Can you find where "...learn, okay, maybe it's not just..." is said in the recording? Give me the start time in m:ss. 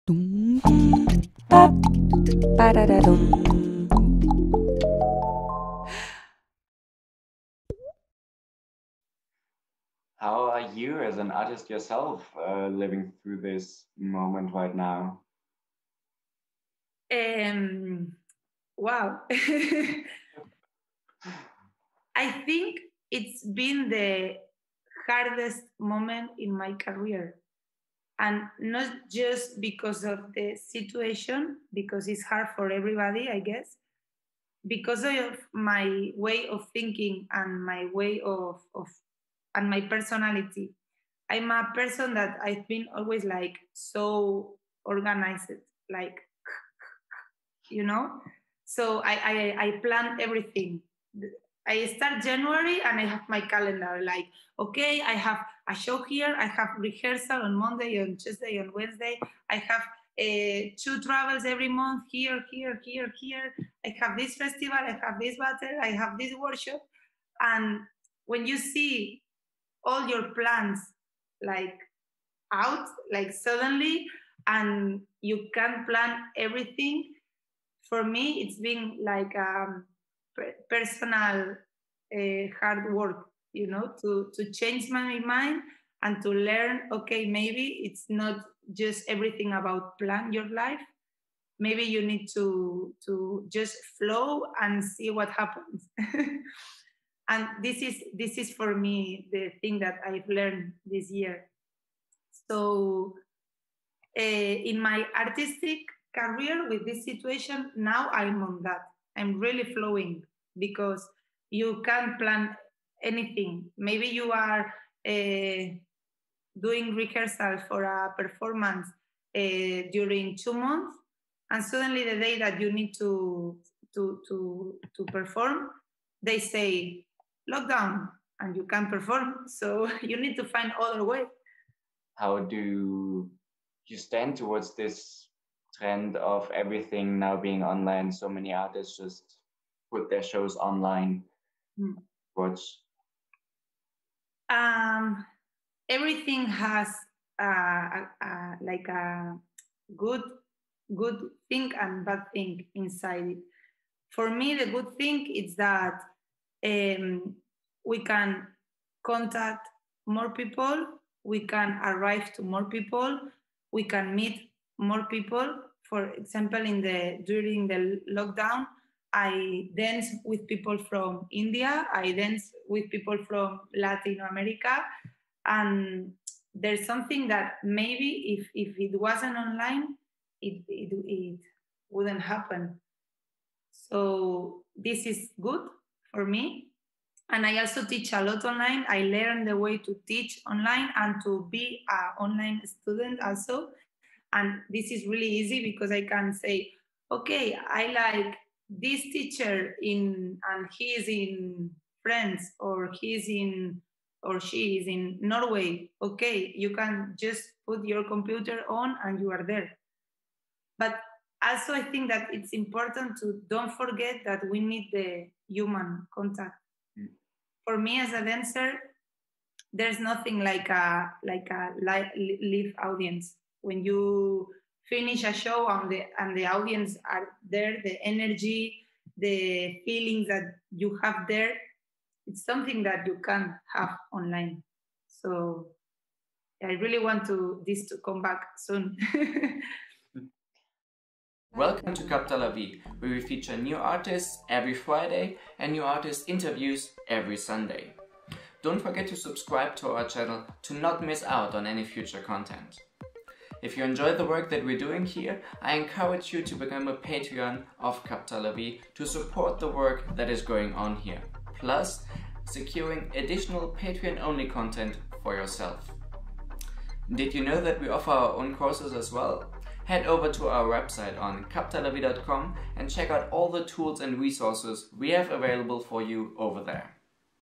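1:26.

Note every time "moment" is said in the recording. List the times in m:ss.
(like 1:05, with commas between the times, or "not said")
0:13, 0:25.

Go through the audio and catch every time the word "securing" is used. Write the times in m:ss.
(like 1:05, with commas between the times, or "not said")
4:22.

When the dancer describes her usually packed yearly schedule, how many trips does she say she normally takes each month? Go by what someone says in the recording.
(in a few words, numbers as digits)
2.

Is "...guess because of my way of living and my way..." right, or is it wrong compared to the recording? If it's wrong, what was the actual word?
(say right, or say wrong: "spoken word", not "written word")
wrong: "thinking", not "living".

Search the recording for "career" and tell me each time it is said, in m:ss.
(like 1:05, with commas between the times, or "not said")
0:26, 1:46.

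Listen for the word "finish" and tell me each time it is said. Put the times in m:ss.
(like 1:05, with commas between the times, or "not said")
3:44.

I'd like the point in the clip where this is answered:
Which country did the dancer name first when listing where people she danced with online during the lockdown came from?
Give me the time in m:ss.
2:51.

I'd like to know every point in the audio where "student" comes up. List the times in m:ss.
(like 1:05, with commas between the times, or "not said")
3:12.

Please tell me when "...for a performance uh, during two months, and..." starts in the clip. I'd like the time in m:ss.
1:57.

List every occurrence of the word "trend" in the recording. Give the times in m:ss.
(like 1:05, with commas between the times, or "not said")
2:15.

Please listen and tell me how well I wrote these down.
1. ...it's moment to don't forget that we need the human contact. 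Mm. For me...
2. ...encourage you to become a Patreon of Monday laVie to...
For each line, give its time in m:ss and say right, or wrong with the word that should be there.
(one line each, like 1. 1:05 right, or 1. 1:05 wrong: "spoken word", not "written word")
1. 3:32 wrong: "important", not "moment"
2. 4:15 wrong: "Capta", not "Monday".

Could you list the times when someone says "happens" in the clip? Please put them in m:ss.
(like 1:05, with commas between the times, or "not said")
1:35, 3:02.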